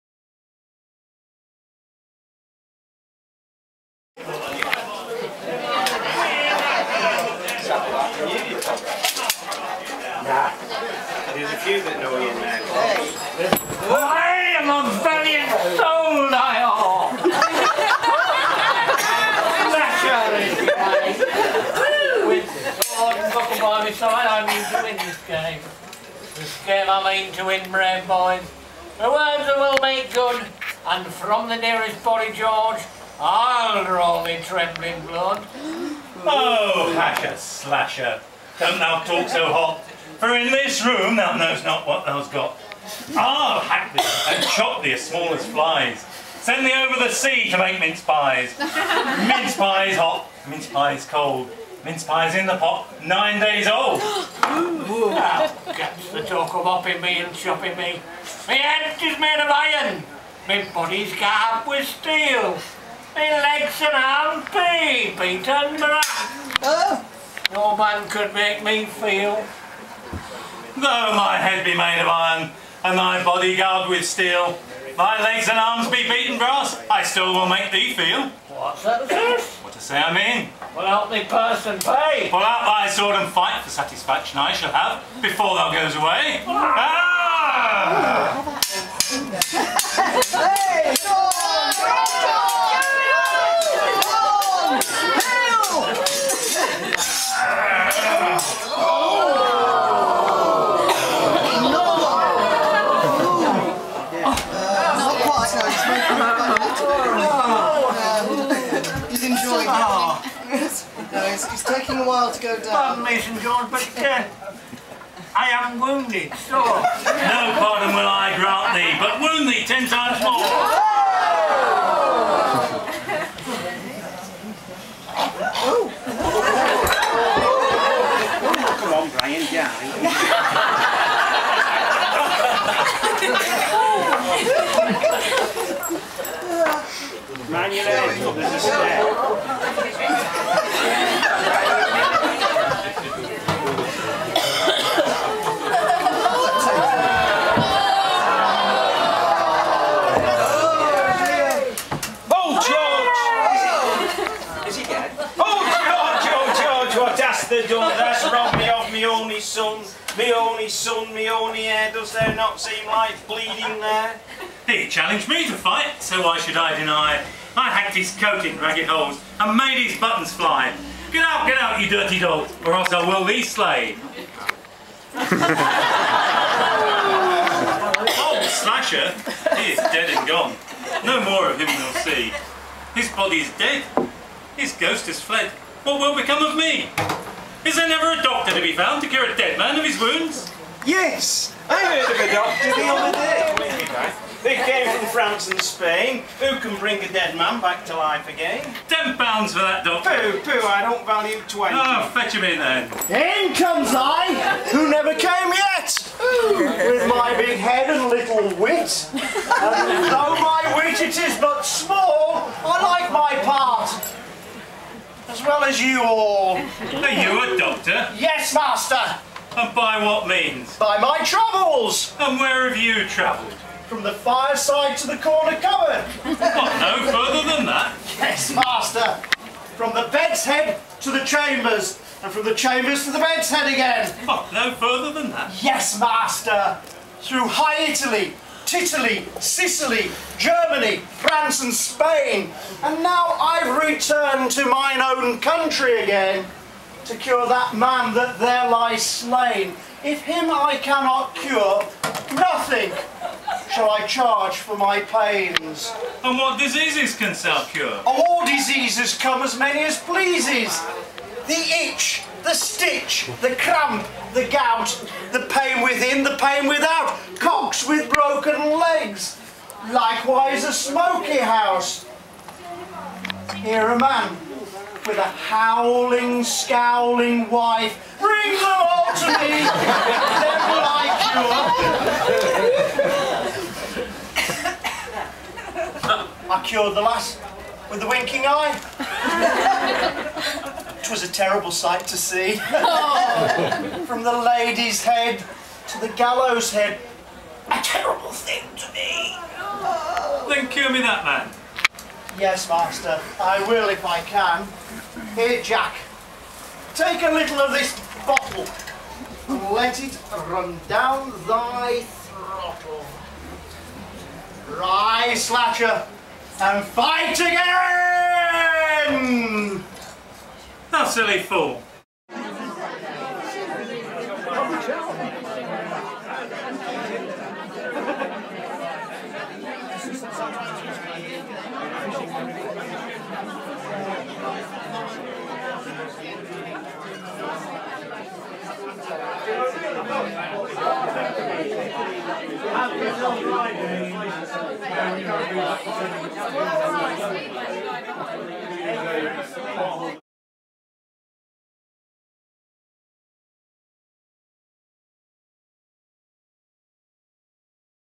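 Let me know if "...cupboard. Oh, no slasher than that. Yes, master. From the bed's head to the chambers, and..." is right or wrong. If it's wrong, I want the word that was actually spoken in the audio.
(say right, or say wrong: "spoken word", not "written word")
wrong: "further", not "slasher".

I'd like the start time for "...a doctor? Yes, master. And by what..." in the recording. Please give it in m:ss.
3:37.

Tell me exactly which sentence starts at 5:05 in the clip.
Here, Jack, take a little of this bottle and let it run down thy throttle.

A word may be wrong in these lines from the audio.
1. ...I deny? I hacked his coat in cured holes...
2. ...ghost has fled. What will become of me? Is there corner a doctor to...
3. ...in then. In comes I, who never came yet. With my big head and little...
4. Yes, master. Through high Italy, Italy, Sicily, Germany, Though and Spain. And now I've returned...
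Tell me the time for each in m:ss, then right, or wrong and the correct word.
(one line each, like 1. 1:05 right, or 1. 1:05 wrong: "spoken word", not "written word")
1. 2:46 wrong: "ragged", not "cured"
2. 3:04 wrong: "never", not "corner"
3. 3:22 right
4. 3:55 wrong: "France", not "Though".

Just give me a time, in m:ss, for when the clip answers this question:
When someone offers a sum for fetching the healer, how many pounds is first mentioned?
3:18.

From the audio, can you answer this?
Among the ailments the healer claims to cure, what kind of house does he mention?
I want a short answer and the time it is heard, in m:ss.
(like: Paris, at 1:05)
a smoky house, at 4:30.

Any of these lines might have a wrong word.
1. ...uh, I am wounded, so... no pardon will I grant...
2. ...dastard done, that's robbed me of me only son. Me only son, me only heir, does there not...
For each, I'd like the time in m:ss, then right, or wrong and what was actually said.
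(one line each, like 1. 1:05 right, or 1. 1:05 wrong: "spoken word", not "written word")
1. 1:54 right
2. 2:37 right.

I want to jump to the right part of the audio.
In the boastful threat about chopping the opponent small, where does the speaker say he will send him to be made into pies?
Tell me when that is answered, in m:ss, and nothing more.
0:46.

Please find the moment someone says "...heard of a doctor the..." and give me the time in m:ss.
3:12.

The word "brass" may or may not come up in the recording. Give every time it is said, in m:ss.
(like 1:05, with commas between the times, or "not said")
1:05, 1:16.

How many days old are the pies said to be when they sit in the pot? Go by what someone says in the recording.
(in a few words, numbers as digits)
9.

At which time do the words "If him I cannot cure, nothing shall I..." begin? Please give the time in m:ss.
4:10.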